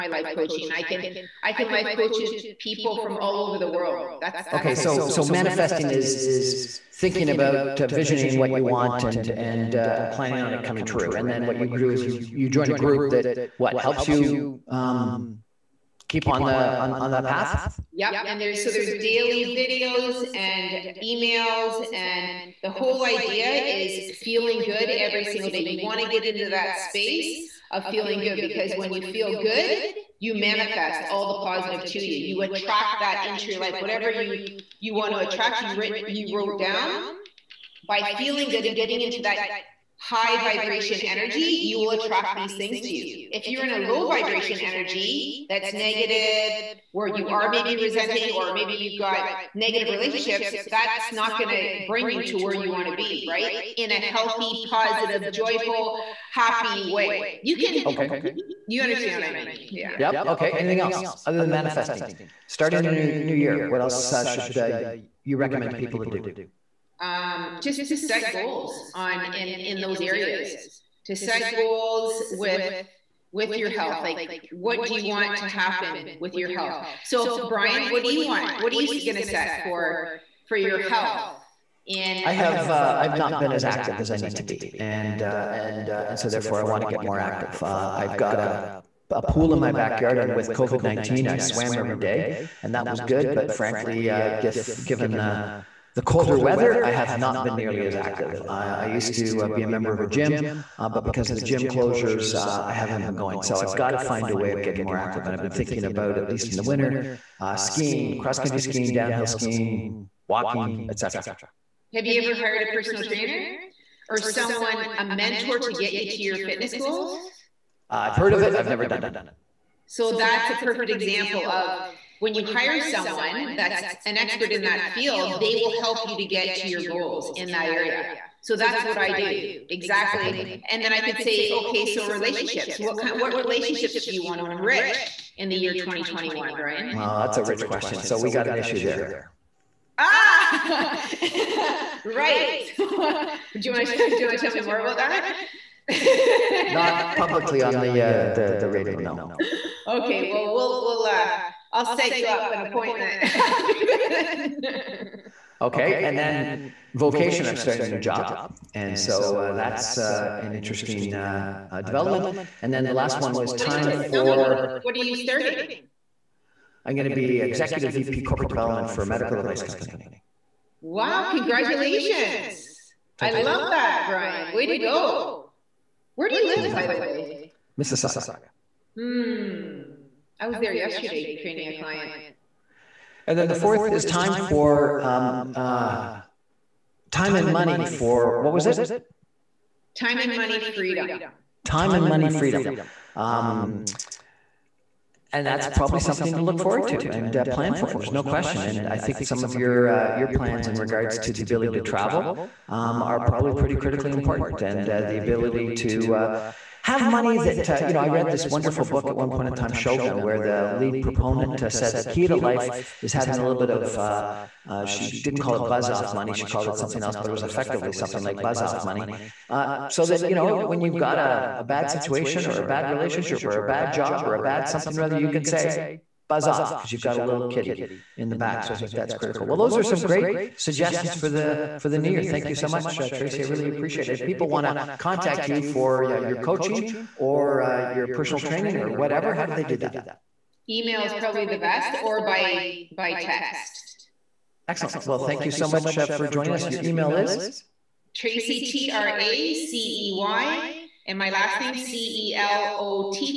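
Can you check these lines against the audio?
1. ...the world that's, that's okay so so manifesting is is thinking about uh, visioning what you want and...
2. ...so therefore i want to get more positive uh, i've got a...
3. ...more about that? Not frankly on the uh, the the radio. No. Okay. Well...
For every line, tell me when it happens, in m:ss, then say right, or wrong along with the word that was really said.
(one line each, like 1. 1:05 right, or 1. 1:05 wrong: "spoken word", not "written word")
1. 0:03 right
2. 1:26 wrong: "active", not "positive"
3. 2:24 wrong: "publicly", not "frankly".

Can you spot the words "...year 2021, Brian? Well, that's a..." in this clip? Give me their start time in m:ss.
2:15.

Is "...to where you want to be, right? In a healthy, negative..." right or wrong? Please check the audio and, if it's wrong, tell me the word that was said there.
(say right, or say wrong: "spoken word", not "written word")
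wrong: "positive", not "negative".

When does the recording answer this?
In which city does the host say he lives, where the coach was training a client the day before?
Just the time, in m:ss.
2:57.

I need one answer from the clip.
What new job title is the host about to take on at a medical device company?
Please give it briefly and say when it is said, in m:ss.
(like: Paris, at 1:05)
executive VP corporate development, at 2:47.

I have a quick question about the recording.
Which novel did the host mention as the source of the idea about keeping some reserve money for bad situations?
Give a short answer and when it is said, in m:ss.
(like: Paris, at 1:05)
Shogun, at 3:29.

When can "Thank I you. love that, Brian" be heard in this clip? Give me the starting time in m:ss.
2:53.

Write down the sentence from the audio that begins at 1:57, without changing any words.
Uh, I've heard of it, I've never done it.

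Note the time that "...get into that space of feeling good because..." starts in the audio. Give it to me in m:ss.
0:26.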